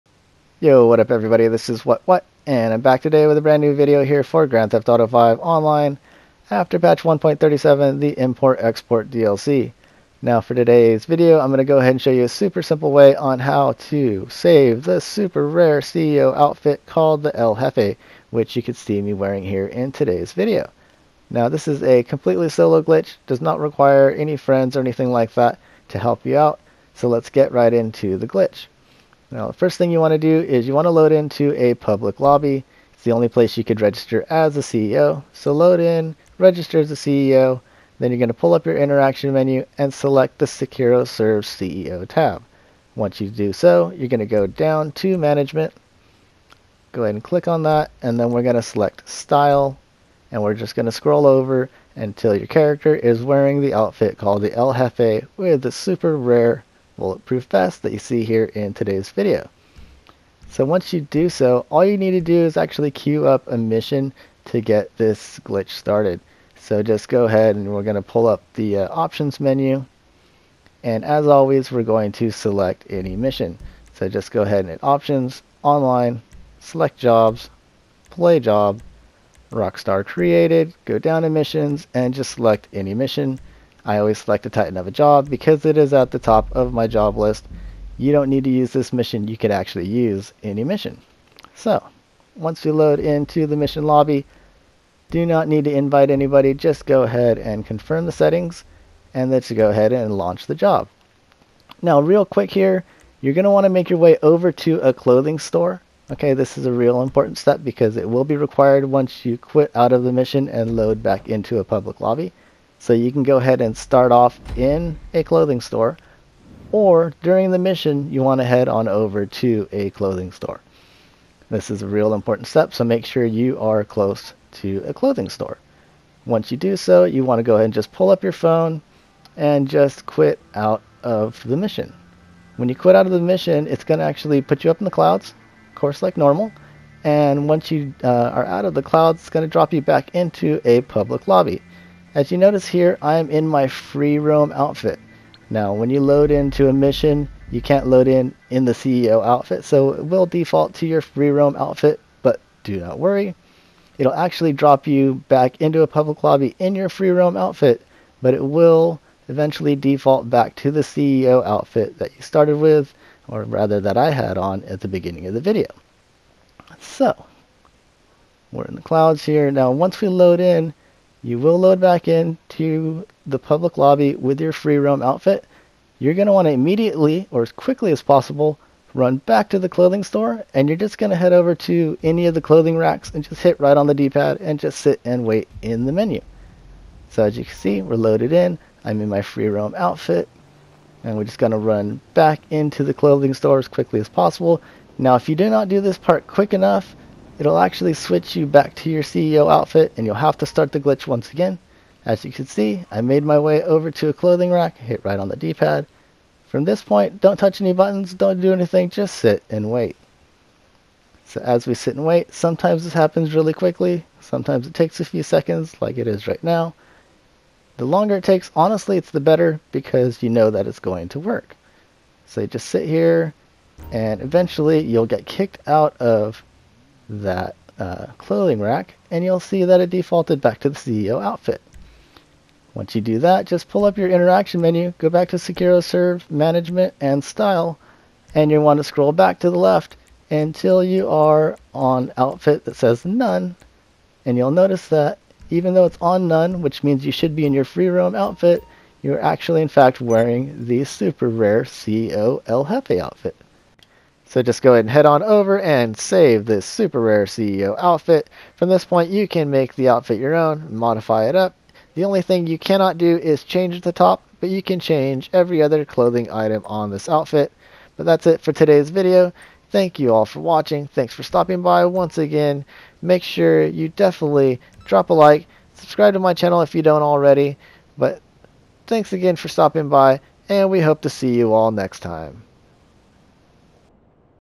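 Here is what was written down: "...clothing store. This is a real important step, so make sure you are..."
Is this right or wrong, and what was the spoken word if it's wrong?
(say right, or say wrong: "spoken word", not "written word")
right.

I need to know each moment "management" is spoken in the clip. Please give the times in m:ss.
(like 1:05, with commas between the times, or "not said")
0:45, 3:56.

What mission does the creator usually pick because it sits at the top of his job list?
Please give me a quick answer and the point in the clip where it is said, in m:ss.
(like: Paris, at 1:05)
Titan of a job, at 1:24.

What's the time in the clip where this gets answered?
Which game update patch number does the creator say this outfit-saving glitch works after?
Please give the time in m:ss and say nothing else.
0:07.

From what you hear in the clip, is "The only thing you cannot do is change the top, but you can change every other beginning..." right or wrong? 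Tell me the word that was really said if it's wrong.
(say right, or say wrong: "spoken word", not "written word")
wrong: "clothing", not "beginning".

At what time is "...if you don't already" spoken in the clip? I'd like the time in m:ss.
4:36.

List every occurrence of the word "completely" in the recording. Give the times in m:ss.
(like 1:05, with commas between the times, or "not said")
0:22.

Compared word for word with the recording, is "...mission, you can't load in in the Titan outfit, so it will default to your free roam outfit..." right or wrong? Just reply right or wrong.
wrong.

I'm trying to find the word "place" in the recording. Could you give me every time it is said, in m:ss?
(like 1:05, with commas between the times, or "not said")
0:33.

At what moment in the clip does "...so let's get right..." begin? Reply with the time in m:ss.
0:26.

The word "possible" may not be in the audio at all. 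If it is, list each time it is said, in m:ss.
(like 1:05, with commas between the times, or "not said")
2:58, 3:14.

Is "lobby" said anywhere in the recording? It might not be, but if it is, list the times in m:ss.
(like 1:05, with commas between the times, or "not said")
0:32, 1:33, 1:51, 2:21, 2:36, 2:53.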